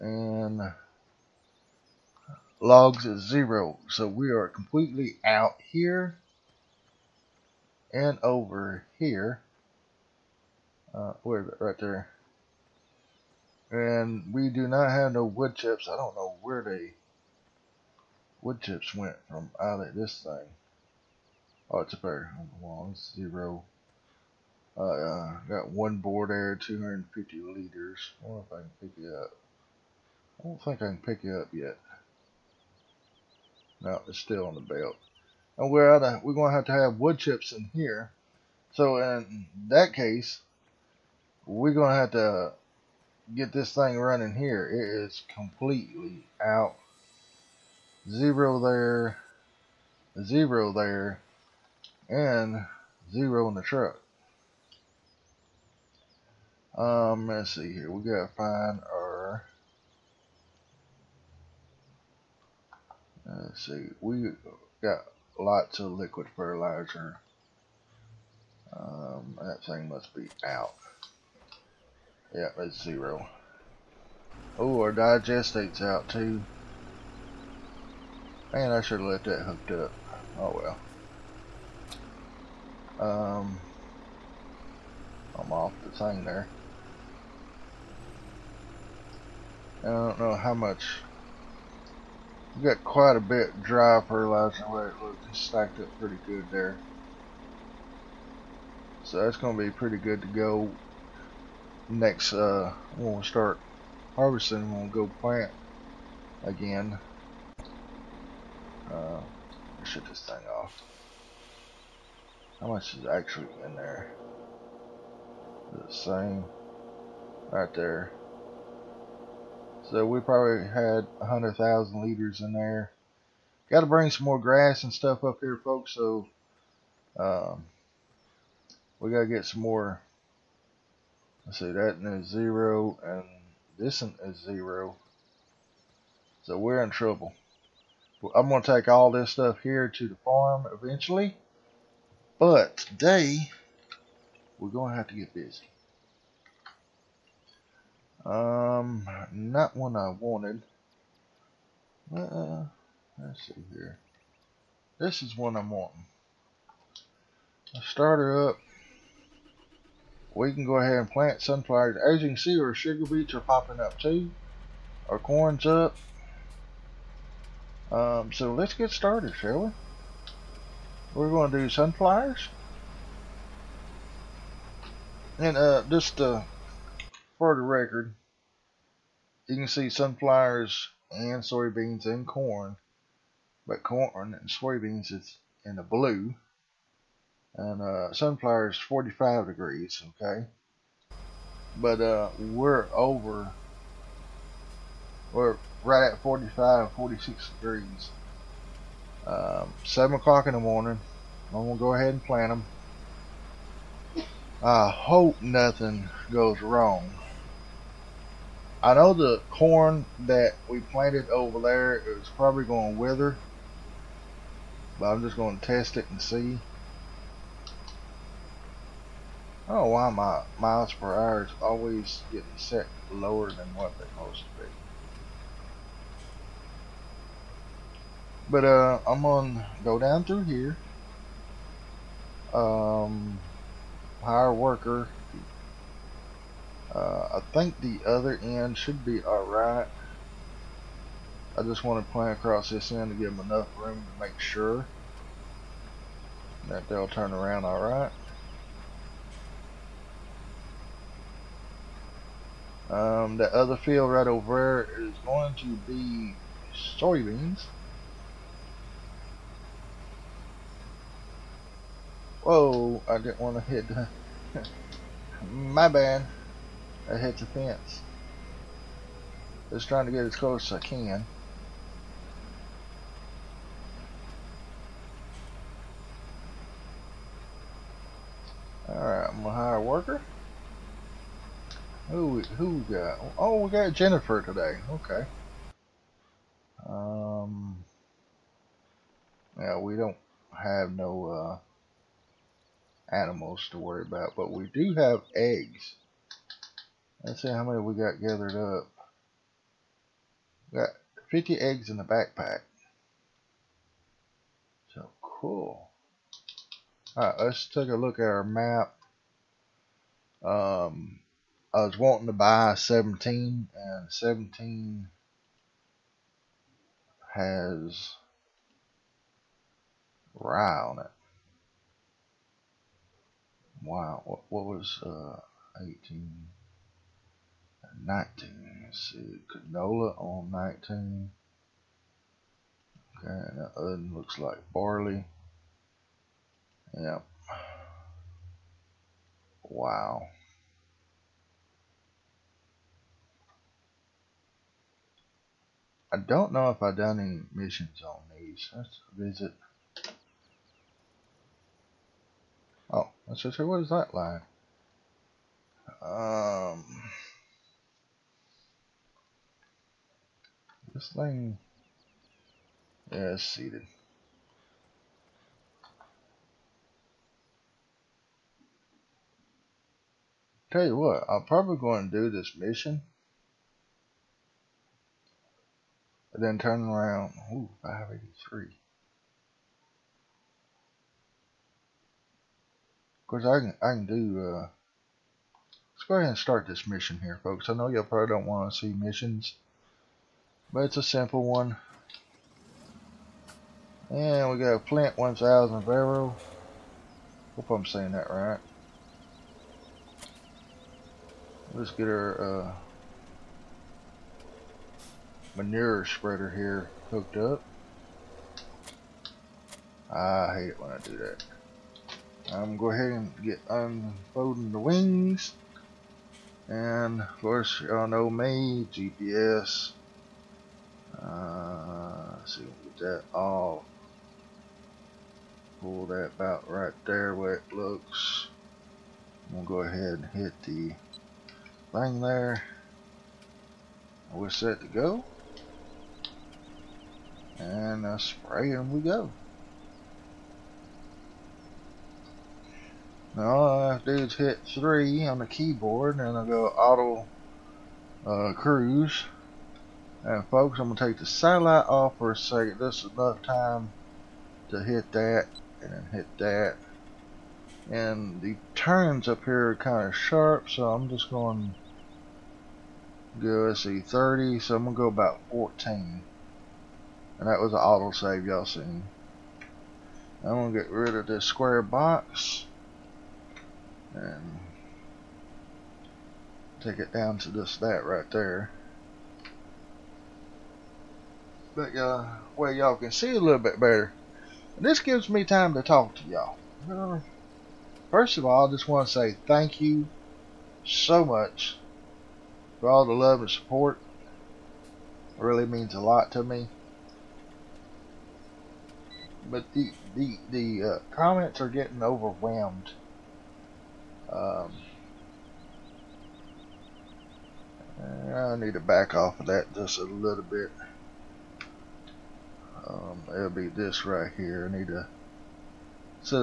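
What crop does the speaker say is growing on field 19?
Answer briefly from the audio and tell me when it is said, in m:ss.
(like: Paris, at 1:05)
Canola, at 5:29.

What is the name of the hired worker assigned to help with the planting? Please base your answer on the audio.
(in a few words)
Jennifer.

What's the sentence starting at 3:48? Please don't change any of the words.
But uh, I'm gonna go down through here.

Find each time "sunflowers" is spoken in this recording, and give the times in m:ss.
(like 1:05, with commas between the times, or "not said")
2:41, 2:51, 2:59, 3:08.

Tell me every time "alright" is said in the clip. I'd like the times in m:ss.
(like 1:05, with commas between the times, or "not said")
3:59, 4:07, 4:38, 5:07.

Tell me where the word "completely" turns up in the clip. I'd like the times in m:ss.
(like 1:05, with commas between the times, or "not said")
0:04, 0:45.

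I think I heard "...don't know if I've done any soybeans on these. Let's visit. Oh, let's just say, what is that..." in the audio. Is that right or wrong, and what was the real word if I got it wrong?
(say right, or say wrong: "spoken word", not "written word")
wrong: "missions", not "soybeans".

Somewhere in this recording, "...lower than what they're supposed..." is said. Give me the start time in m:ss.
3:43.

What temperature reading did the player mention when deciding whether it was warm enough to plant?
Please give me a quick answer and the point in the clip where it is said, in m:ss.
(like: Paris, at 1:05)
45-46 degrees, at 3:16.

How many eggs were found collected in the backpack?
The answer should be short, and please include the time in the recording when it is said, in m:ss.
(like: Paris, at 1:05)
50, at 5:01.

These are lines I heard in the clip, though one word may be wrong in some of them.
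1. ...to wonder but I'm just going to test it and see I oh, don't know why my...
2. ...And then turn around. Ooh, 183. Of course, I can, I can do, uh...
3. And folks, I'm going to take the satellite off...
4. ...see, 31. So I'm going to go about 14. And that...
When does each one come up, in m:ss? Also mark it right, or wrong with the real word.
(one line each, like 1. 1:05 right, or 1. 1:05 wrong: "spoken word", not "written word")
1. 3:32 wrong: "wither", not "wonder"
2. 6:16 wrong: "583", not "183"
3. 7:30 right
4. 7:43 wrong: "30", not "31".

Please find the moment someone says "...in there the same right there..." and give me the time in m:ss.
1:53.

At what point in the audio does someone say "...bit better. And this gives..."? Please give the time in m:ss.
8:03.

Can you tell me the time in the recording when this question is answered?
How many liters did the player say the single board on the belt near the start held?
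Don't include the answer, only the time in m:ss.
0:26.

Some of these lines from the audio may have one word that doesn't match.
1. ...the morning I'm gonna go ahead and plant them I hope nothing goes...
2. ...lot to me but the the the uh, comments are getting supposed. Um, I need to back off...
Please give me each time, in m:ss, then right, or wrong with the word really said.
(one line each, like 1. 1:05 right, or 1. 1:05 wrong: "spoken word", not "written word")
1. 3:20 right
2. 8:16 wrong: "overwhelmed", not "supposed".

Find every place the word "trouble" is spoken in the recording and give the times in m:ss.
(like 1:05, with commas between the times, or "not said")
2:16.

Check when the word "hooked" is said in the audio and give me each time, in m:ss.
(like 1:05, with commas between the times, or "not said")
1:19, 6:47.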